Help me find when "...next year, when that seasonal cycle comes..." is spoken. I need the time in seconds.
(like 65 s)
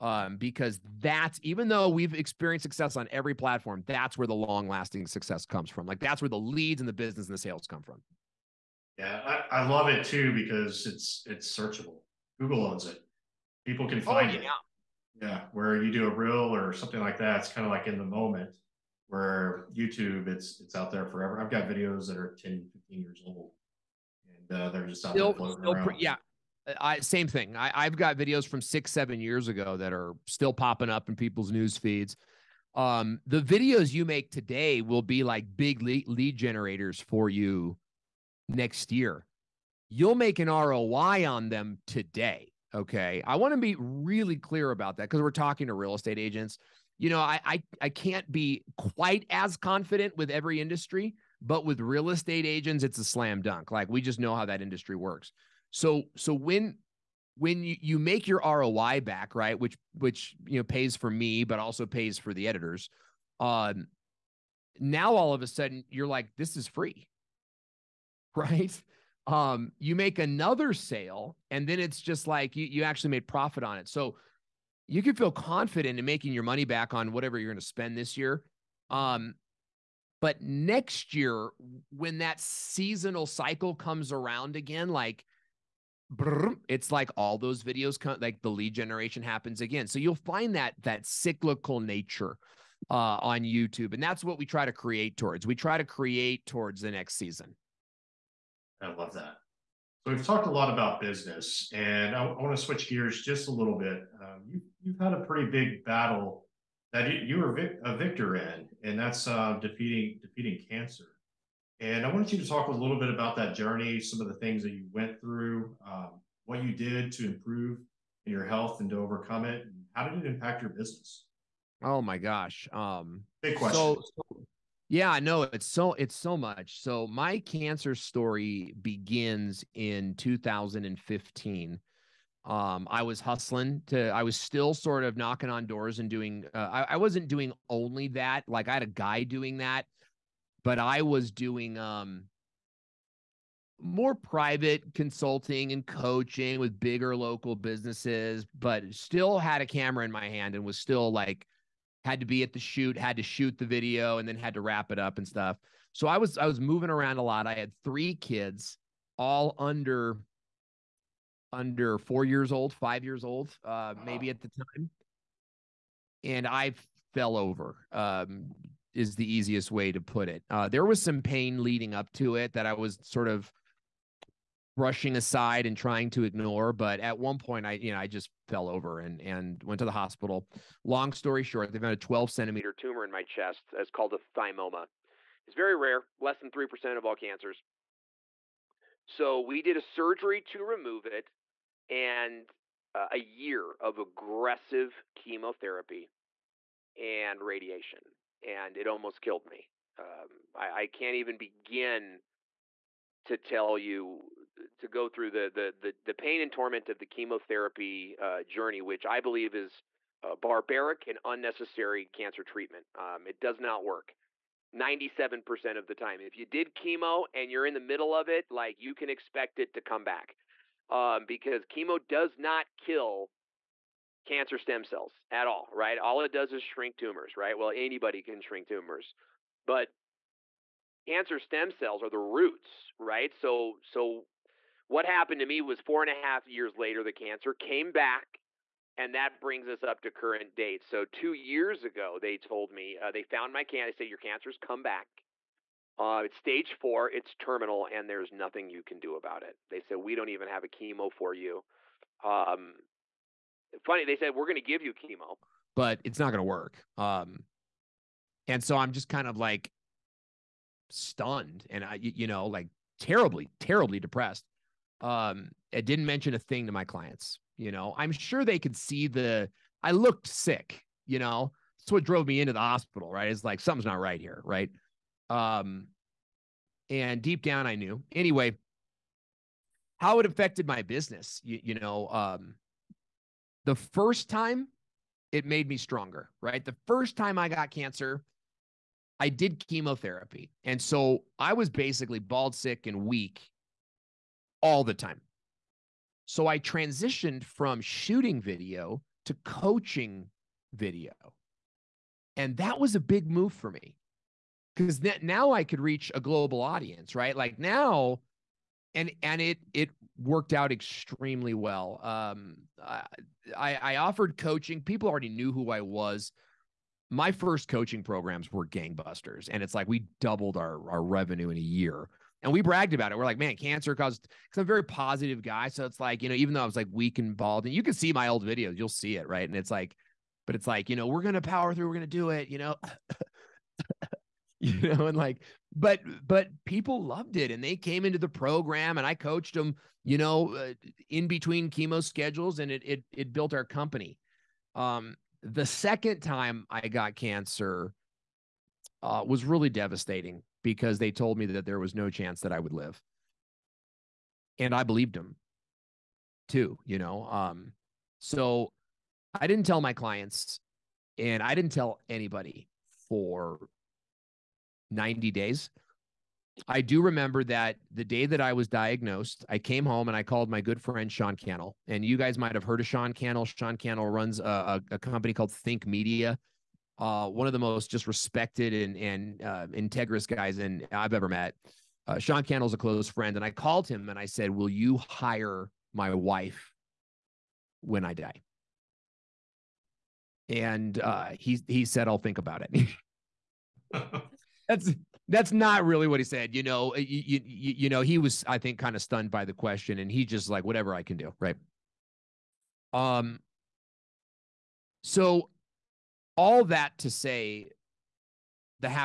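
80 s.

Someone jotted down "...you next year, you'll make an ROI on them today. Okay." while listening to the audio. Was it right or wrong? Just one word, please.
right.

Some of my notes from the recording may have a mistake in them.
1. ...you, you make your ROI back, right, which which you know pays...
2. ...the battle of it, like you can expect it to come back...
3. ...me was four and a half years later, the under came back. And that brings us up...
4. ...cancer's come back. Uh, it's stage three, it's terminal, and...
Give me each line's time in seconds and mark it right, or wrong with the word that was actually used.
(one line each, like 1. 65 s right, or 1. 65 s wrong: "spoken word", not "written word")
1. 57 s right
2. 217 s wrong: "middle", not "battle"
3. 235 s wrong: "cancer", not "under"
4. 244 s wrong: "four", not "three".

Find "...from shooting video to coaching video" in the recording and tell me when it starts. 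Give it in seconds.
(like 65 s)
297 s.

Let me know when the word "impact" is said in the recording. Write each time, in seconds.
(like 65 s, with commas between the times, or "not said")
120 s.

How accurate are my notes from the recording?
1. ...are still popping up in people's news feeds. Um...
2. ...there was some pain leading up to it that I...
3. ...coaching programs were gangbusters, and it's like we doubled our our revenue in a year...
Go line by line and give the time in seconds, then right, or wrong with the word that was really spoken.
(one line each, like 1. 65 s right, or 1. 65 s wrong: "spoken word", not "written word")
1. 29 s right
2. 170 s right
3. 317 s right.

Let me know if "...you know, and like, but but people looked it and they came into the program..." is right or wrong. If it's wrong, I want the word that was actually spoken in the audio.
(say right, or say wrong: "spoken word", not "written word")
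wrong: "loved", not "looked".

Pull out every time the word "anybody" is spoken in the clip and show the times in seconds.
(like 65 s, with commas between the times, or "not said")
227 s, 362 s.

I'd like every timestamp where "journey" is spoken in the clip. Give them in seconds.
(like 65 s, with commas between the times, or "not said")
113 s, 208 s.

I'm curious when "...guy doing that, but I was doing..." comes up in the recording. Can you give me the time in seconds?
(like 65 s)
138 s.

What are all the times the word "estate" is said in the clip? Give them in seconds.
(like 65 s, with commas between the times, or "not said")
45 s, 52 s.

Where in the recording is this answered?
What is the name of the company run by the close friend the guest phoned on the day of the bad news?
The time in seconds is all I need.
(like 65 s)
375 s.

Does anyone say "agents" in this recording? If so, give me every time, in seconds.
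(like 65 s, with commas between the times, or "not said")
46 s, 52 s.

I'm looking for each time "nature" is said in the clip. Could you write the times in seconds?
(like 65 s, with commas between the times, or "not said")
91 s.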